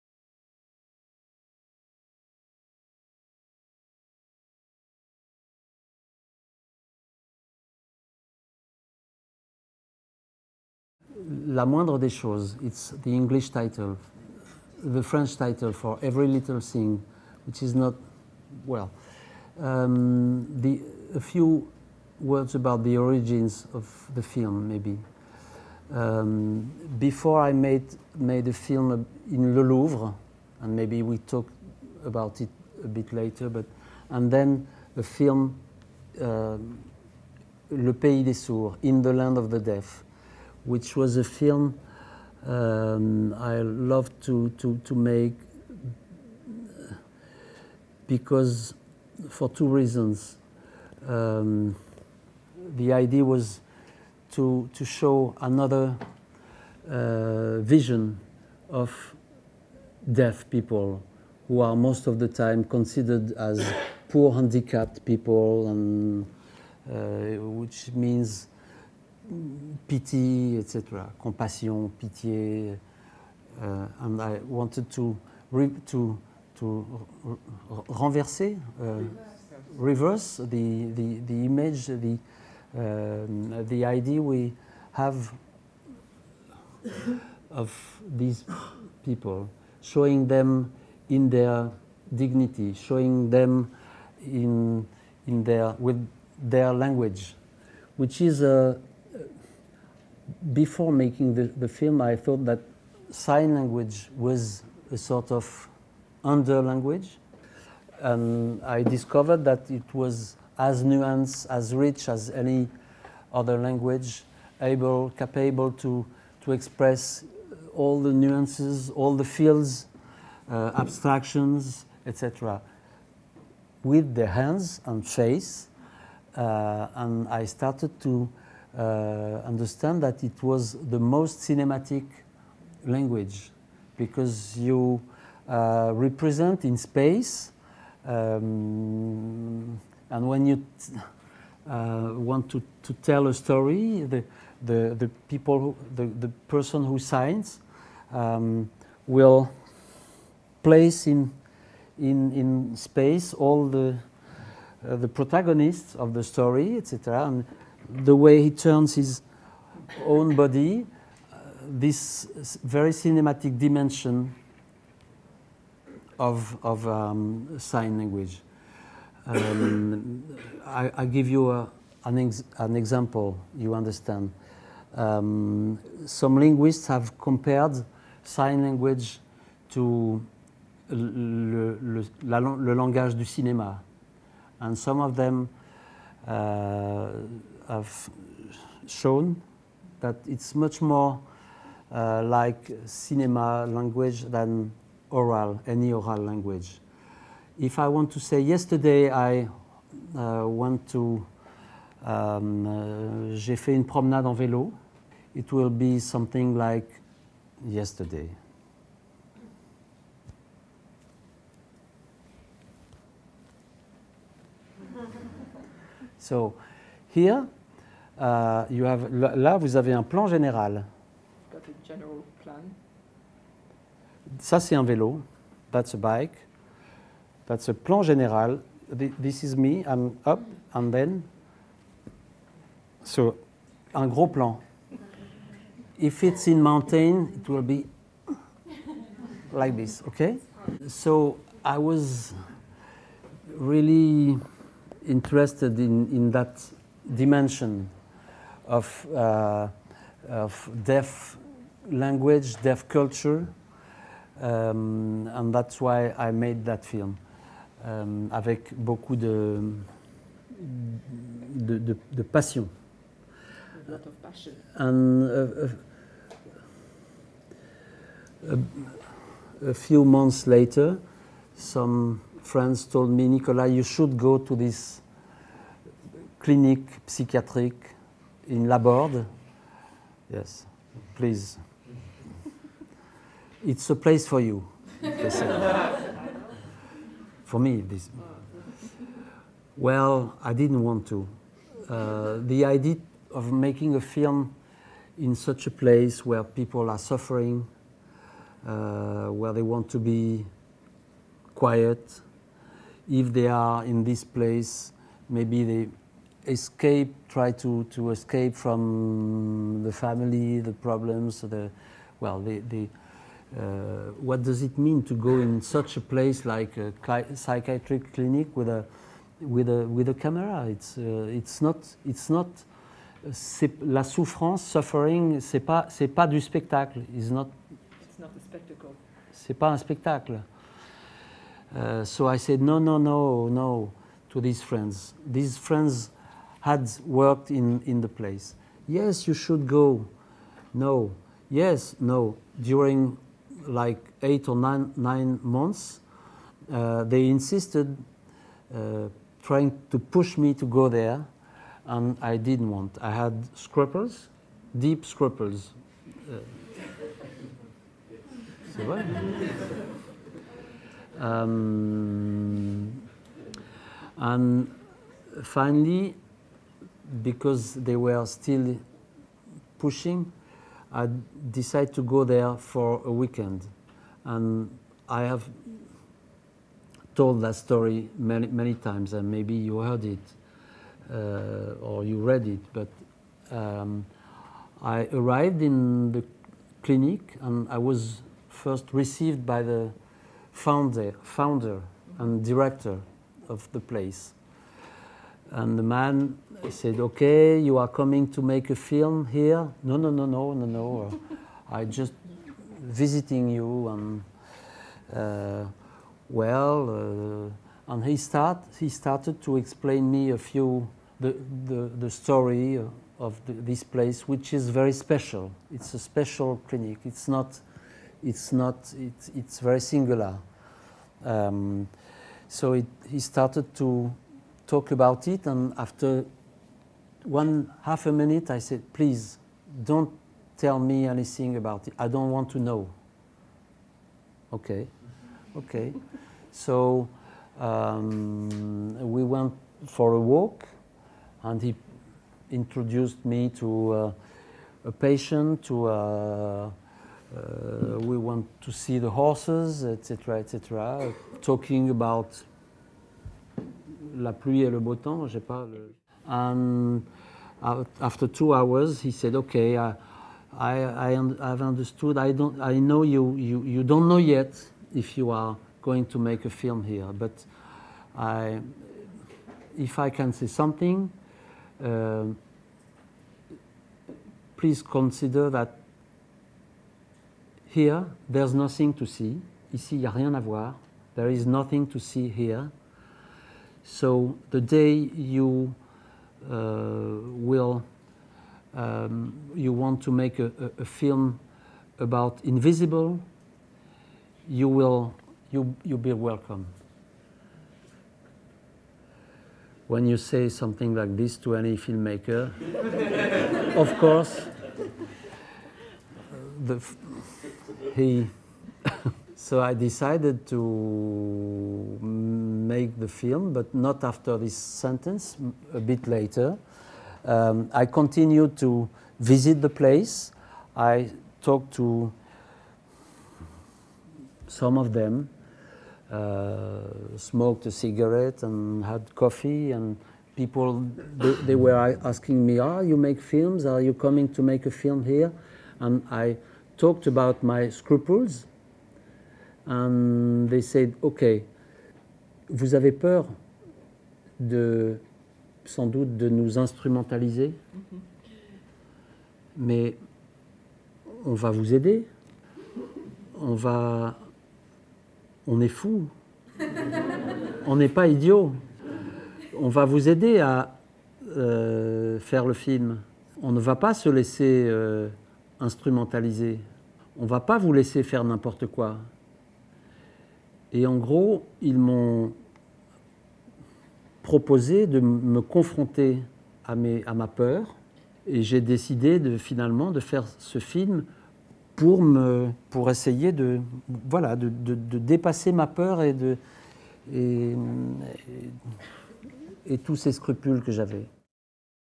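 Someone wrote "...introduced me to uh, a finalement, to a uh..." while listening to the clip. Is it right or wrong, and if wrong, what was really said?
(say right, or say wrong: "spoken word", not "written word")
wrong: "patient", not "finalement".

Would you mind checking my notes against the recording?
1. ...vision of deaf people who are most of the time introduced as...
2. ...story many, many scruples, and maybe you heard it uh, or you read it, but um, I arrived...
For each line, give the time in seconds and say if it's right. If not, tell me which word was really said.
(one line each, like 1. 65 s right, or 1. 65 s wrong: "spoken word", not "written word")
1. 57 s wrong: "considered", not "introduced"
2. 377 s wrong: "times", not "scruples".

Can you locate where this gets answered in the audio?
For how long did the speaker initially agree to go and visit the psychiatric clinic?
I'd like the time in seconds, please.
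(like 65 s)
373 s.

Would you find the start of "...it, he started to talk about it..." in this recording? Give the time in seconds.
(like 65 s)
422 s.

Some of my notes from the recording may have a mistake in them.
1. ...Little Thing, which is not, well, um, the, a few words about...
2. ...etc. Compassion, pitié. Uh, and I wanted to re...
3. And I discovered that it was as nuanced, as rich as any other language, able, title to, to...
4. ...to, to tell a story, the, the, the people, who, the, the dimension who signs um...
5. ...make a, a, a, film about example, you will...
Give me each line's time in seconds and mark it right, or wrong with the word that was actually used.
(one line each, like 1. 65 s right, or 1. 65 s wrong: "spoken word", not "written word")
1. 16 s right
2. 70 s right
3. 107 s wrong: "capable", not "title"
4. 142 s wrong: "person", not "dimension"
5. 490 s wrong: "invisible", not "example".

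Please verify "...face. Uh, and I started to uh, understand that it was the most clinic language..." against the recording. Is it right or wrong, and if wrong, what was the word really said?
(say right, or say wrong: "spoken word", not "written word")
wrong: "cinematic", not "clinic".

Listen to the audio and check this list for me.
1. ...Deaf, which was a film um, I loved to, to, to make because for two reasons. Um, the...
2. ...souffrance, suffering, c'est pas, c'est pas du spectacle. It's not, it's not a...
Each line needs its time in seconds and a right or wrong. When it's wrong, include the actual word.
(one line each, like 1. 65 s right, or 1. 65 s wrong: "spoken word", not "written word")
1. 39 s right
2. 324 s right.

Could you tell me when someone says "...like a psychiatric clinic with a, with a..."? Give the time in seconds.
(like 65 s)
316 s.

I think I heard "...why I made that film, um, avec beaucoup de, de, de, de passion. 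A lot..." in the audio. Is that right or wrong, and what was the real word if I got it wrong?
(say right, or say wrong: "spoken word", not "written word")
right.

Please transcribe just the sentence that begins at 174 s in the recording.
Um, some linguists have compared sign language to le, le, la, le, langage du cinéma.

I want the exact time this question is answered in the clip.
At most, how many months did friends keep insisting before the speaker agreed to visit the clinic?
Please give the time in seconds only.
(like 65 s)
344 s.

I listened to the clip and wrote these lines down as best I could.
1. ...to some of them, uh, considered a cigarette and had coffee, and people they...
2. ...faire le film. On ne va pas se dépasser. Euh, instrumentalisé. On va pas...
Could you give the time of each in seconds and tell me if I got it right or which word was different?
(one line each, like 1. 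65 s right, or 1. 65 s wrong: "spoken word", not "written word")
1. 521 s wrong: "smoked", not "considered"
2. 562 s wrong: "laisser", not "dépasser".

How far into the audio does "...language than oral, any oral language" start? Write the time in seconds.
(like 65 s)
193 s.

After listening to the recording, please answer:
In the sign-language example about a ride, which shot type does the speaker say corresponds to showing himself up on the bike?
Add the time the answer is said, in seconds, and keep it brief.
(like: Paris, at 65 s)
gros plan, at 233 s.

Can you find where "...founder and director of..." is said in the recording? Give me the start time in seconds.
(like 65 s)
391 s.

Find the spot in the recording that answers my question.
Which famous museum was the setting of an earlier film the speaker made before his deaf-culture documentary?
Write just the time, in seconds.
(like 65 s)
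29 s.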